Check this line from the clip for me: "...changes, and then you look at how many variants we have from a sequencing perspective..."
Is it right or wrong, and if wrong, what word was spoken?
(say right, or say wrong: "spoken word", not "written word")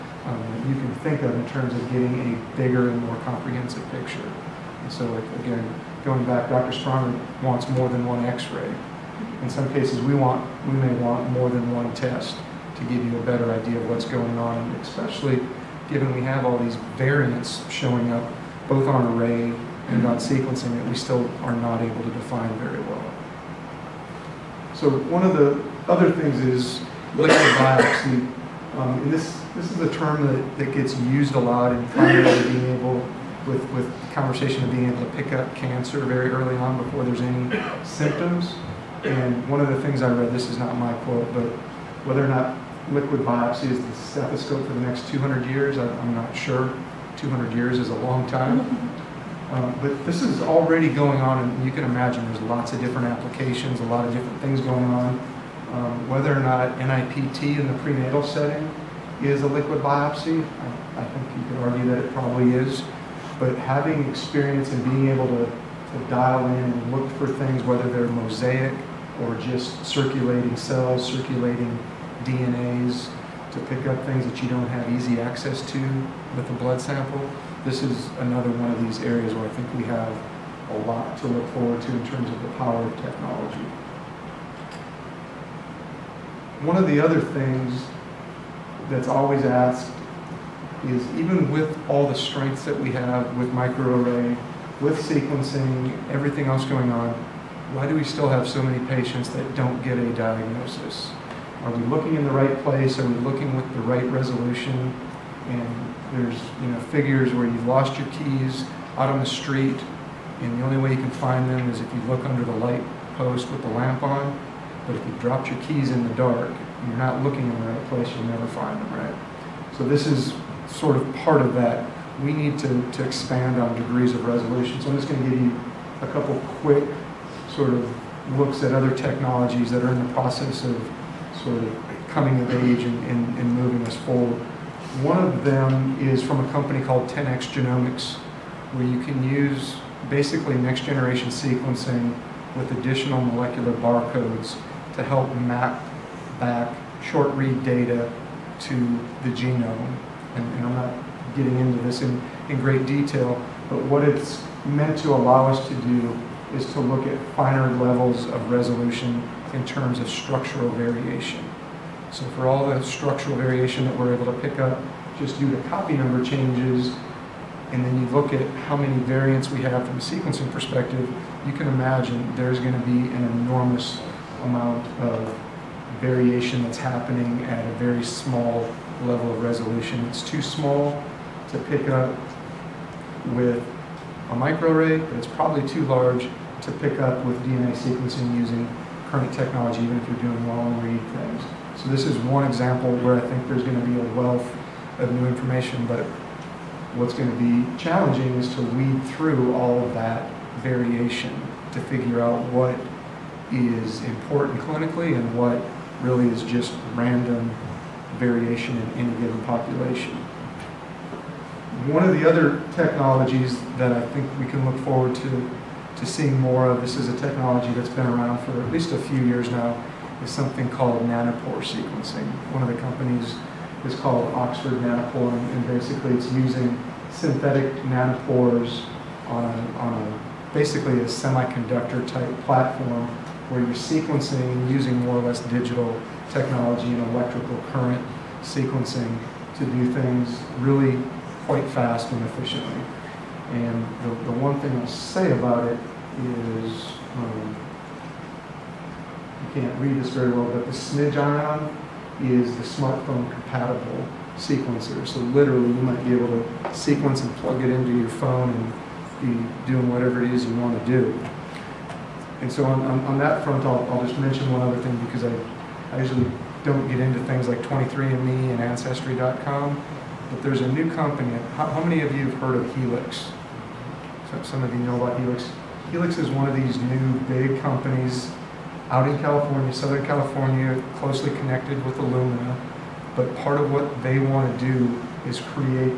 right.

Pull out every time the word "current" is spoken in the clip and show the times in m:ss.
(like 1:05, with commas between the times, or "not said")
3:09, 3:57.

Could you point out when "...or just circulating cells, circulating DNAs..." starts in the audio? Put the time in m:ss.
1:09.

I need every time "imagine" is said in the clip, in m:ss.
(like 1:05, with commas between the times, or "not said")
0:51, 2:51.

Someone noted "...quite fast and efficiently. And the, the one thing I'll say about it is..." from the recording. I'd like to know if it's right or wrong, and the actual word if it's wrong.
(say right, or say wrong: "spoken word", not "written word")
right.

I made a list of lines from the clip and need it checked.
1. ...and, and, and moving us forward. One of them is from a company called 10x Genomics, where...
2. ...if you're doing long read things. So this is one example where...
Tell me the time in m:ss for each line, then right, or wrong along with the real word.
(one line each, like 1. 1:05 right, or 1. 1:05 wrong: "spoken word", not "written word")
1. 2:12 right
2. 3:09 right.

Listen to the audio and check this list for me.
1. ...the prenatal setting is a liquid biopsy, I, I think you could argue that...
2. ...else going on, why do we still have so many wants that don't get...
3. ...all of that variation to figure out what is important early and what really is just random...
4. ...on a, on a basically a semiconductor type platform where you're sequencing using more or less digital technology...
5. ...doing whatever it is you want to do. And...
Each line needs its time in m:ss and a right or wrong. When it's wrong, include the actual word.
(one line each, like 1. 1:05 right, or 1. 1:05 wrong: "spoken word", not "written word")
1. 0:57 right
2. 1:36 wrong: "patients", not "wants"
3. 3:19 wrong: "clinically", not "early"
4. 3:49 right
5. 4:19 right.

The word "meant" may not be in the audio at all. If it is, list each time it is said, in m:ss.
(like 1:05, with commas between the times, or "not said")
2:34.